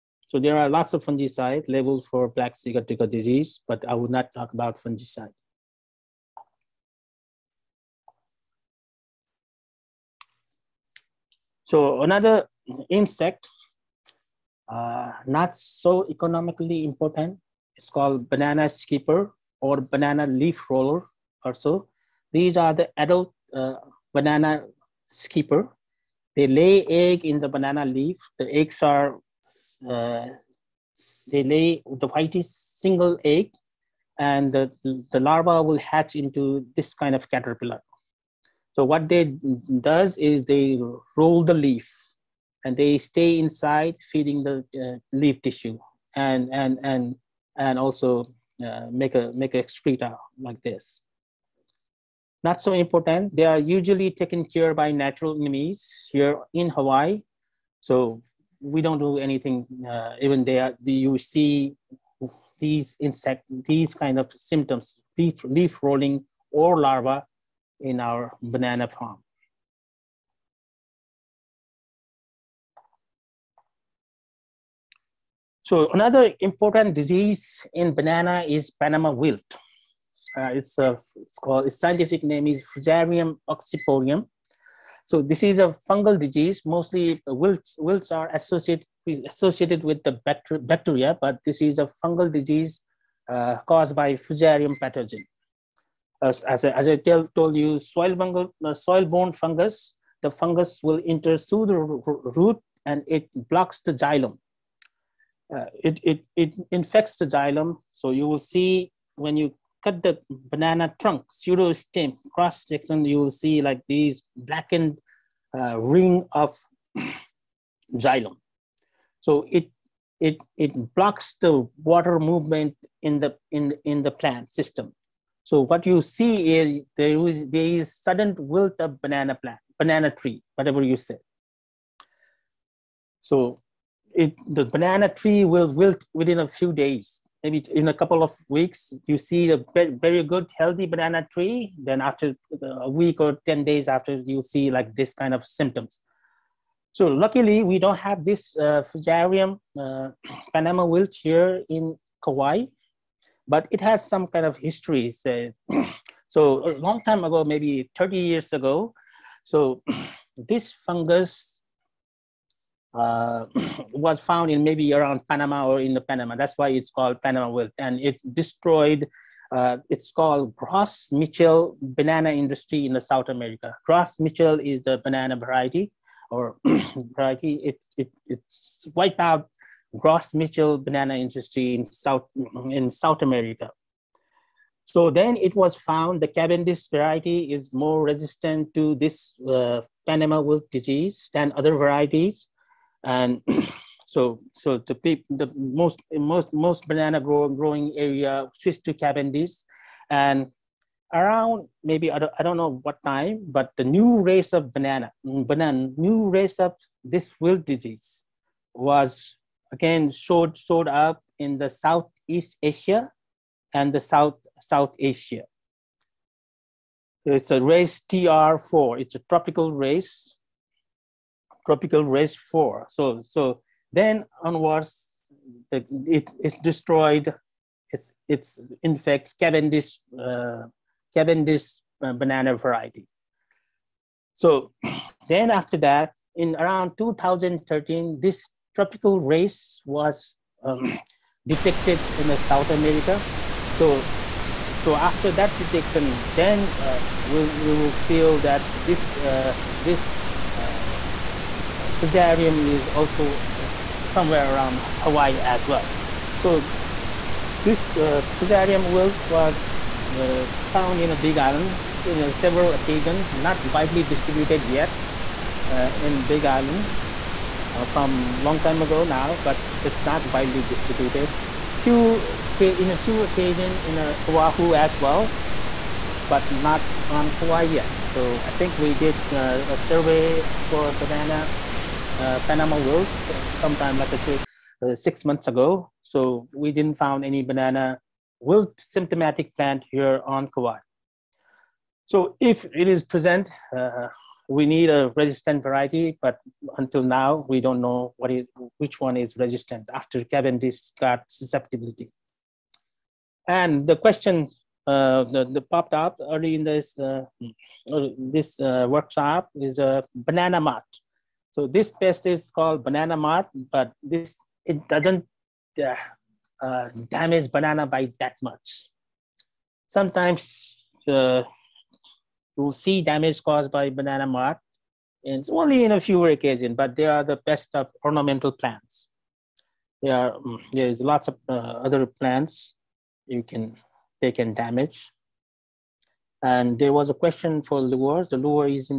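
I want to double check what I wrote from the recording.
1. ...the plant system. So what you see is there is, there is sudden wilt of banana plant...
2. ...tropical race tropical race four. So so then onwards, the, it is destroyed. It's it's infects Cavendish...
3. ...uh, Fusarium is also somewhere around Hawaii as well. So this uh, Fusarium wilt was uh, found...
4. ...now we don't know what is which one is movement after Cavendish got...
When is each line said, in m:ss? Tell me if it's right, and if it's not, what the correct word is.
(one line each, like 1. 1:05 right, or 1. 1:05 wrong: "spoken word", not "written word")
1. 2:04 right
2. 3:39 right
3. 4:11 right
4. 4:57 wrong: "resistant", not "movement".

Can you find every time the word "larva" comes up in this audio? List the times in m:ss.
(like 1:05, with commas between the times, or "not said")
0:35, 1:06.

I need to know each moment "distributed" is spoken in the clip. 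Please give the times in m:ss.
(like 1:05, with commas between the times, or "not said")
4:24, 4:30.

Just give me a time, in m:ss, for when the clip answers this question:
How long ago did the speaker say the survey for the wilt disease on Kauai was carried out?
4:44.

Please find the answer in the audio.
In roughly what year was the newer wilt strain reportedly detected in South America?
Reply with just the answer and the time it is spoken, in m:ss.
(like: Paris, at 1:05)
2013, at 3:56.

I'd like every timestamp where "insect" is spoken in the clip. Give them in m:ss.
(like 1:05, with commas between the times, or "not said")
0:12, 1:02.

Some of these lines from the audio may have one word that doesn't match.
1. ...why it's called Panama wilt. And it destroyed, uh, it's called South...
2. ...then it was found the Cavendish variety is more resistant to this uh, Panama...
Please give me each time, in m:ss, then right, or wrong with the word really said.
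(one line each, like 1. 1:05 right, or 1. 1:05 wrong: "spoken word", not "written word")
1. 2:46 wrong: "Gross", not "South"
2. 3:05 right.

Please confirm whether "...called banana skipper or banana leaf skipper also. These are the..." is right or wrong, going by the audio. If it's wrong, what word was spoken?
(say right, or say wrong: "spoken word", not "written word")
wrong: "roller", not "skipper".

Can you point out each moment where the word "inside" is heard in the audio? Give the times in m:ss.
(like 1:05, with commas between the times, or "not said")
0:43.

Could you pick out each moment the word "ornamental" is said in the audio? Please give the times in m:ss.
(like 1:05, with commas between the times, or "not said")
5:28.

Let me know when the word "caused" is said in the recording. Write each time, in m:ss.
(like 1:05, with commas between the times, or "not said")
1:33, 5:23.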